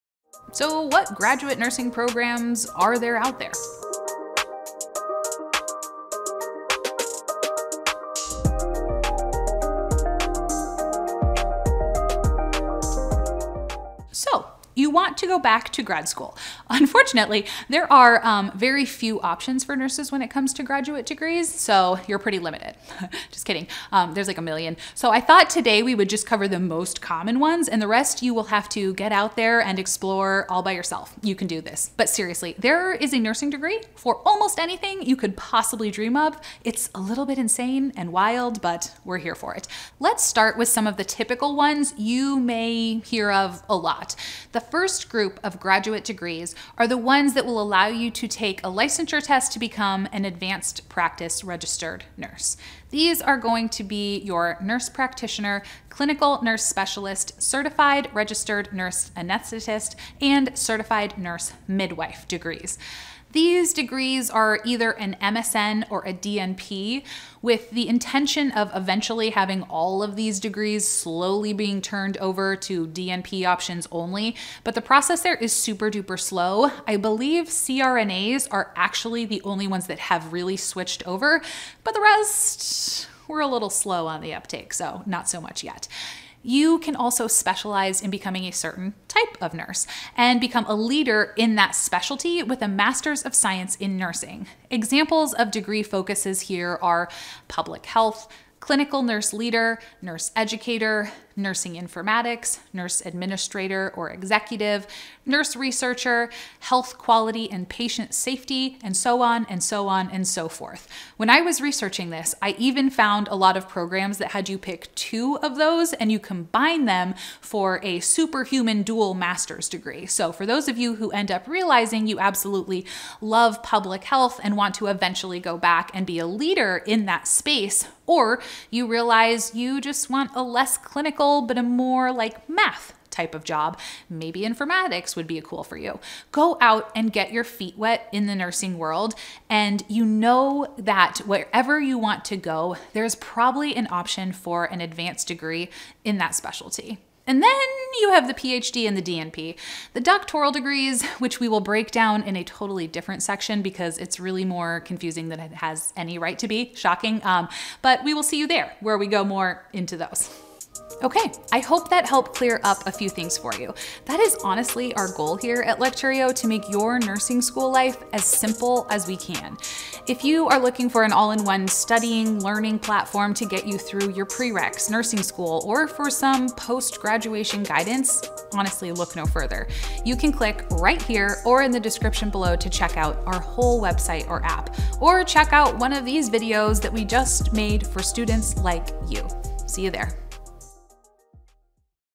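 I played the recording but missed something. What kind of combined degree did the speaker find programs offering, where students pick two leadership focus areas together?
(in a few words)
dual master's degree.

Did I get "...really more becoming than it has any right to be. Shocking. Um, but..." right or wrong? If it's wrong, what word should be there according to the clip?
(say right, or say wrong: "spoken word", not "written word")
wrong: "confusing", not "becoming".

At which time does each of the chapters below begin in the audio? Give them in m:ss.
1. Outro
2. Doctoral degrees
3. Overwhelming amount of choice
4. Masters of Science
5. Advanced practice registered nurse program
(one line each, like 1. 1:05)
1. 2:40
2. 2:27
3. 0:14
4. 1:26
5. 0:44.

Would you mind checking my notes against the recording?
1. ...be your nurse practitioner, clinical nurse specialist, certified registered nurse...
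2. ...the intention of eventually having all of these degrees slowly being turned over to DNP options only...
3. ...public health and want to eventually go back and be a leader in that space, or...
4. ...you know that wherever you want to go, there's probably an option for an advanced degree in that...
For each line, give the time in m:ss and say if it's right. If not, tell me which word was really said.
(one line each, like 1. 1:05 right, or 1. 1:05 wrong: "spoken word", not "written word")
1. 0:53 right
2. 1:07 right
3. 2:03 right
4. 2:19 right.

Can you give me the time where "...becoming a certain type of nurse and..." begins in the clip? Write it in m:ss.
1:28.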